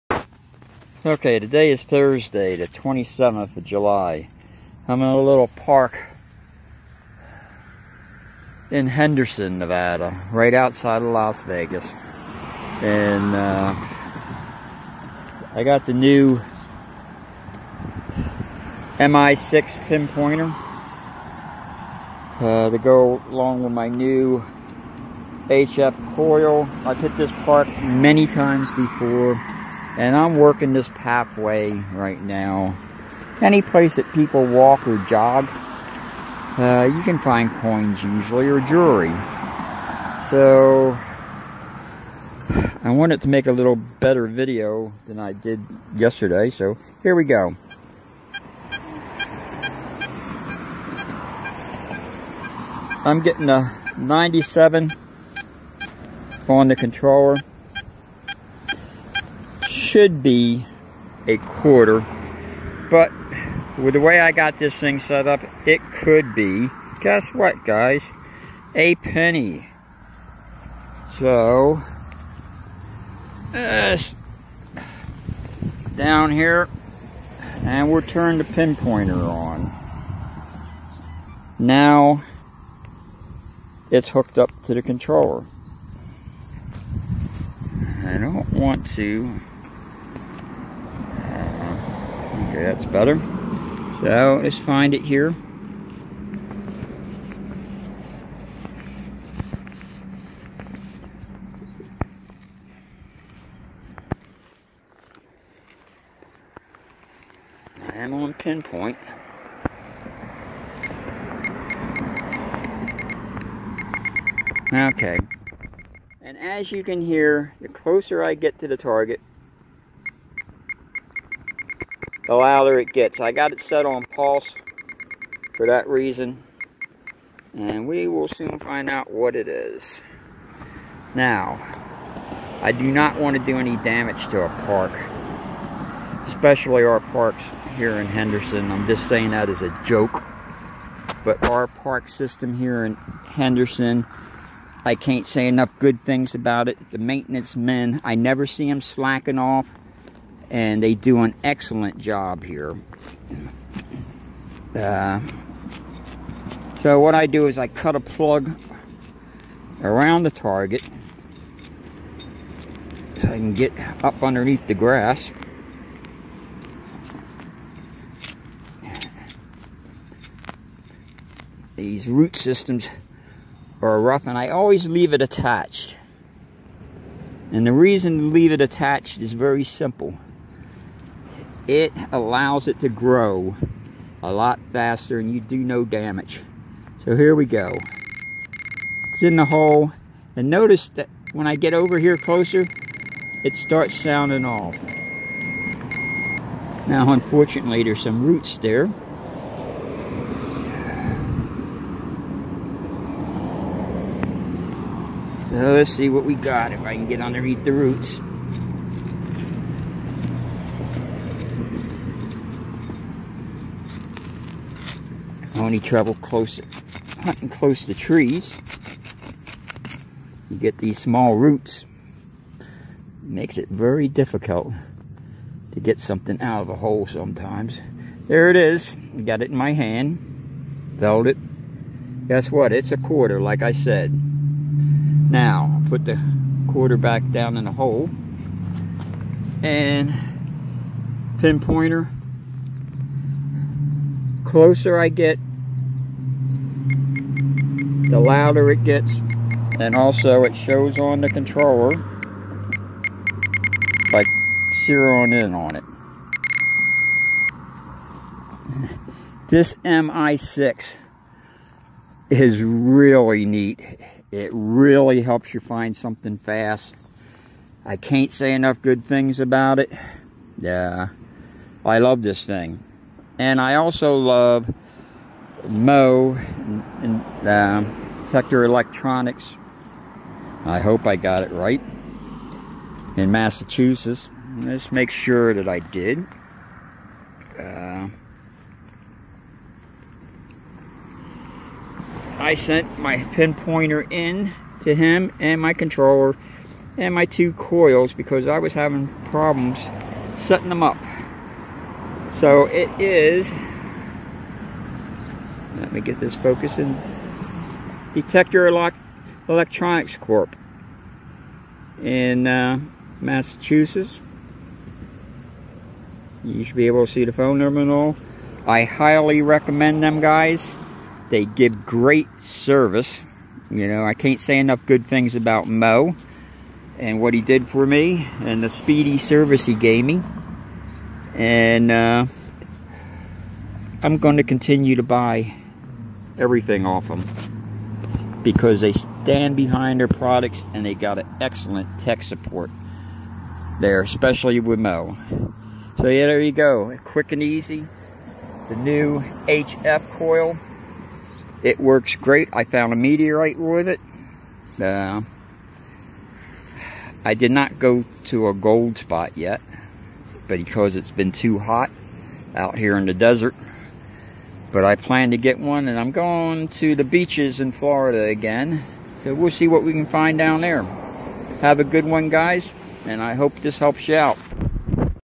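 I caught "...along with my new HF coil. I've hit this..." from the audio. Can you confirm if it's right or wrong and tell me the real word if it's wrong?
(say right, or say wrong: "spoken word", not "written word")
right.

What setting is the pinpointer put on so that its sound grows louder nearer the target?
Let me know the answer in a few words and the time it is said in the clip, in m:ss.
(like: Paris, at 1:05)
pulse, at 2:04.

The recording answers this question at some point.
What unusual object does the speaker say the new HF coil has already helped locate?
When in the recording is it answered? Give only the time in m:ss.
5:52.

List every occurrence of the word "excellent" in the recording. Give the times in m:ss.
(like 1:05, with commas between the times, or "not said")
2:31, 5:41.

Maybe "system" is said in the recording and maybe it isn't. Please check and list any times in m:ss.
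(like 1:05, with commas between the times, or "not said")
2:22, 2:52.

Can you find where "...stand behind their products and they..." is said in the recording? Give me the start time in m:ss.
5:38.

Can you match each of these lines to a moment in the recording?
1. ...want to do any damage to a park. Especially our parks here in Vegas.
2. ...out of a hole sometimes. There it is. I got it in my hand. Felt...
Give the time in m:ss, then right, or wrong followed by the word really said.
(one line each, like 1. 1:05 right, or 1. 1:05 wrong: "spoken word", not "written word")
1. 2:13 wrong: "Henderson", not "Vegas"
2. 3:46 right.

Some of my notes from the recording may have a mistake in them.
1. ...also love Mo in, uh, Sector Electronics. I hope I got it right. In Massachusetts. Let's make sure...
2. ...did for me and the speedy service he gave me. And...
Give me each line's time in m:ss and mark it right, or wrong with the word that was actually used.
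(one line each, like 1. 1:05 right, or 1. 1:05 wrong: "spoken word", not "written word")
1. 4:33 right
2. 5:27 right.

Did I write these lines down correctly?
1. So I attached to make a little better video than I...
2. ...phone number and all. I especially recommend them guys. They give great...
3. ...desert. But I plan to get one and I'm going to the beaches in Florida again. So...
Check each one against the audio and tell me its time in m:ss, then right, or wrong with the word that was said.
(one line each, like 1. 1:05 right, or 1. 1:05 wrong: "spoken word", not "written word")
1. 0:40 wrong: "wanted", not "attached"
2. 5:17 wrong: "highly", not "especially"
3. 6:03 right.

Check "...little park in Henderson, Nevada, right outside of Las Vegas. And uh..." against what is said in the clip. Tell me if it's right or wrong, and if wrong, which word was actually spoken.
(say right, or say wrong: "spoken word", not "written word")
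right.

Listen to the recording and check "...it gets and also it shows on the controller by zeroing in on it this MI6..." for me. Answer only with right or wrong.
right.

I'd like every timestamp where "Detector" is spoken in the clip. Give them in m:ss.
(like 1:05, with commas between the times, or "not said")
5:08.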